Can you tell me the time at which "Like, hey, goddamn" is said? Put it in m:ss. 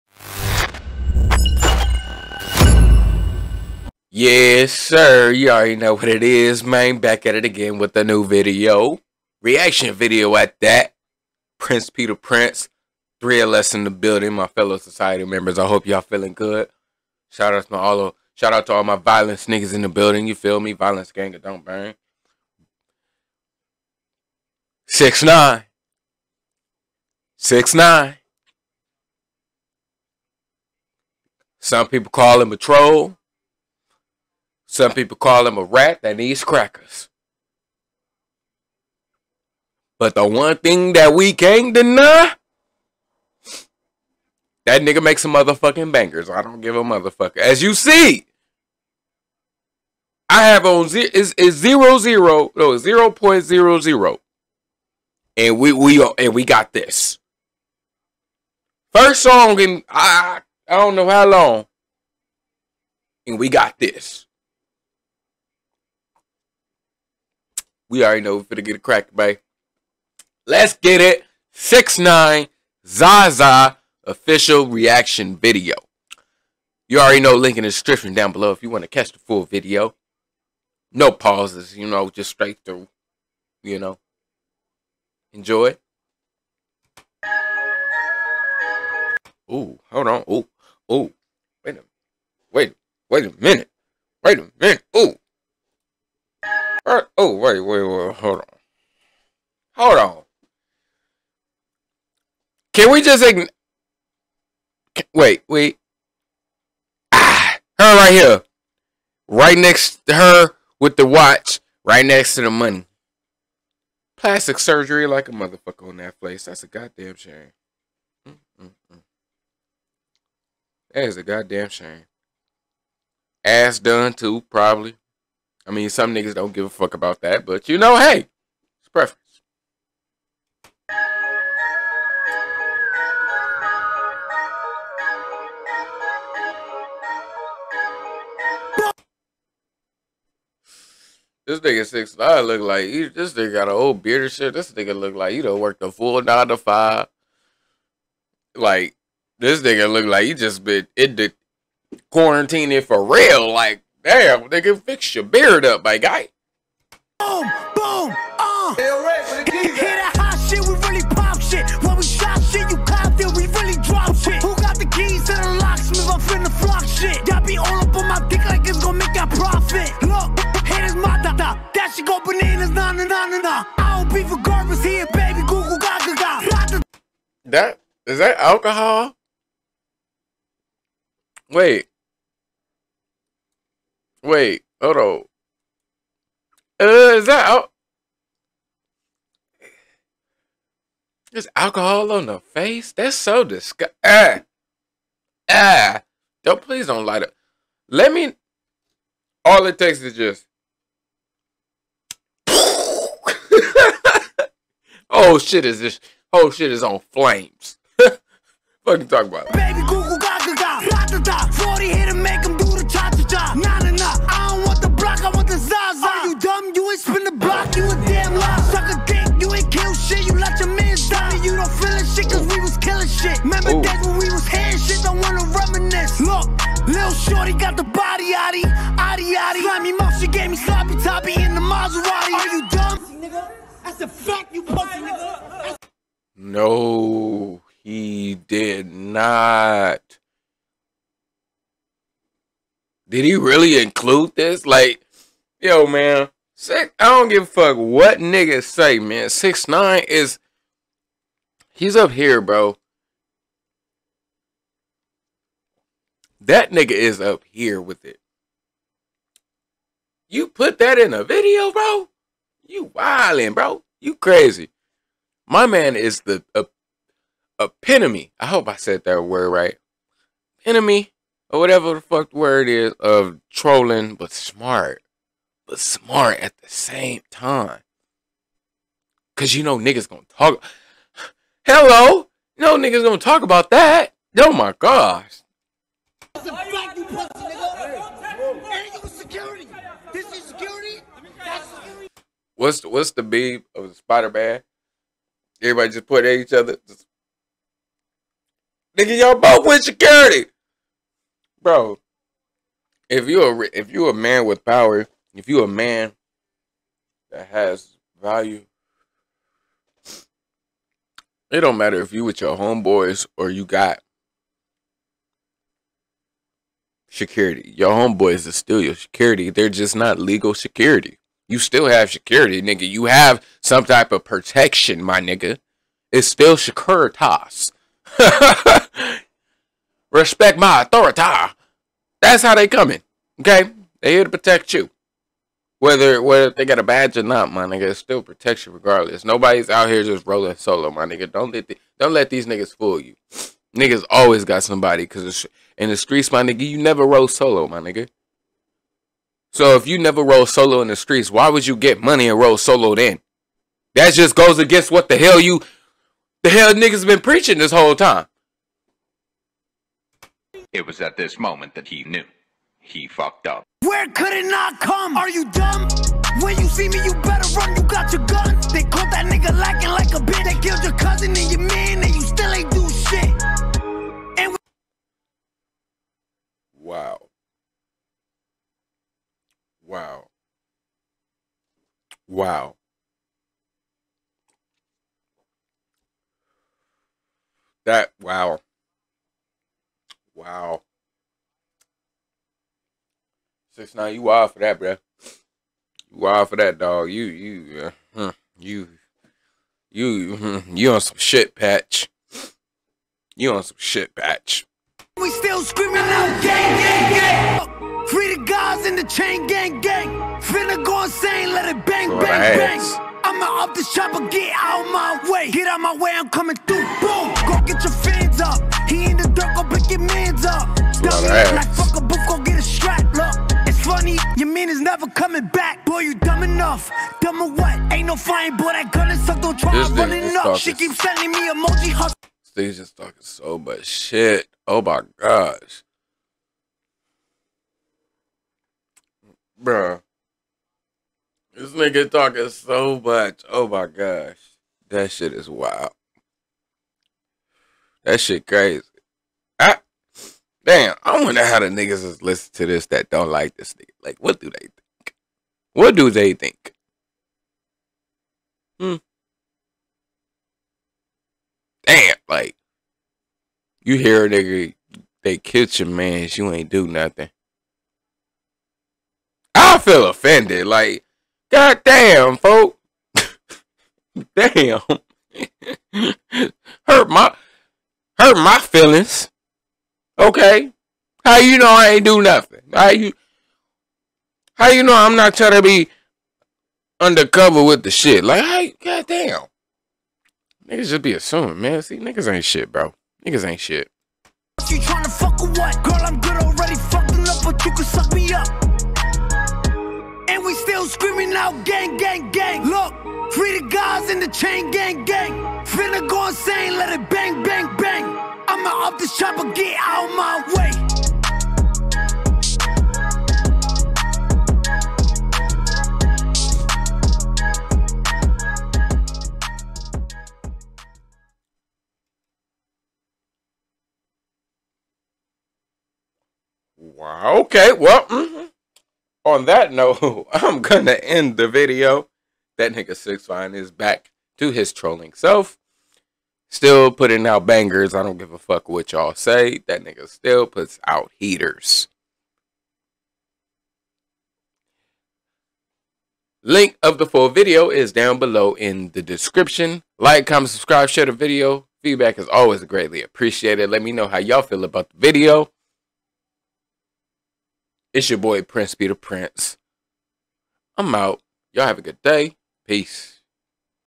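8:08.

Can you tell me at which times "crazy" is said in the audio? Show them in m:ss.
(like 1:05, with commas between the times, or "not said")
4:24, 7:28.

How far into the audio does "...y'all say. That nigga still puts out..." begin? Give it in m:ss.
8:58.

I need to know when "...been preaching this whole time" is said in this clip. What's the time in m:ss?
5:57.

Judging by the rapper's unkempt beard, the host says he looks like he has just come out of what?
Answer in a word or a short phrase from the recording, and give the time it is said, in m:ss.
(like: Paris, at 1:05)
Quarantine, at 2:32.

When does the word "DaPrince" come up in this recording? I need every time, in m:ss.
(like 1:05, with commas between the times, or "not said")
0:12, 9:18.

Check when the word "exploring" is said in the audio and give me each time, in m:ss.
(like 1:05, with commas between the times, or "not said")
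not said.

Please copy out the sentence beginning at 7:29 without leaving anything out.
I, damn, I wonder how the niggas is listen to this that don't like this nigga.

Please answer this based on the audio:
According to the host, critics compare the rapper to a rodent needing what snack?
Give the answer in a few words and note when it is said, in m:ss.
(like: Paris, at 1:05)
Crackers, at 0:36.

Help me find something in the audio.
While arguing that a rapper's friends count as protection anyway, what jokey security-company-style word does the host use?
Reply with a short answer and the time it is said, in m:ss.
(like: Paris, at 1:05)
Securitas, at 5:26.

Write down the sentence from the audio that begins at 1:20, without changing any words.
No pauses, you know, just straight through.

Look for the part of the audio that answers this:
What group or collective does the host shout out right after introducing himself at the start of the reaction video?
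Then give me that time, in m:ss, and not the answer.
0:13.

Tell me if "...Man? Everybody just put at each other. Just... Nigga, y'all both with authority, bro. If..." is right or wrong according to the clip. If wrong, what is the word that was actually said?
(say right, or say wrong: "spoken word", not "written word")
wrong: "security", not "authority".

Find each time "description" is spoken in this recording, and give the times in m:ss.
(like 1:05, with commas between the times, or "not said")
1:17, 9:09.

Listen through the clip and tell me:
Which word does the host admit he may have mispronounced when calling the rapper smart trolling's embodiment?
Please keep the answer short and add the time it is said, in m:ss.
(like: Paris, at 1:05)
Epitome, at 4:27.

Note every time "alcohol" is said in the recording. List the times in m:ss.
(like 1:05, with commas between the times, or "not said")
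2:58, 3:11.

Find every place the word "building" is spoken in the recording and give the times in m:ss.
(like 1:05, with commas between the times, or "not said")
0:13, 0:19.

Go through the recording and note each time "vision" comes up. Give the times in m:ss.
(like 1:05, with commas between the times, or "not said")
not said.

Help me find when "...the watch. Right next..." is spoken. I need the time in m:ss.
1:50.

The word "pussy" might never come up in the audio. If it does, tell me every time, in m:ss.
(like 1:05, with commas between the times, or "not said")
3:54, 4:47.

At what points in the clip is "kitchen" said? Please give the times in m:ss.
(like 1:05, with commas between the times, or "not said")
7:45.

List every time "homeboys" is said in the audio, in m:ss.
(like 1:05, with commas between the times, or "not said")
5:12, 5:17.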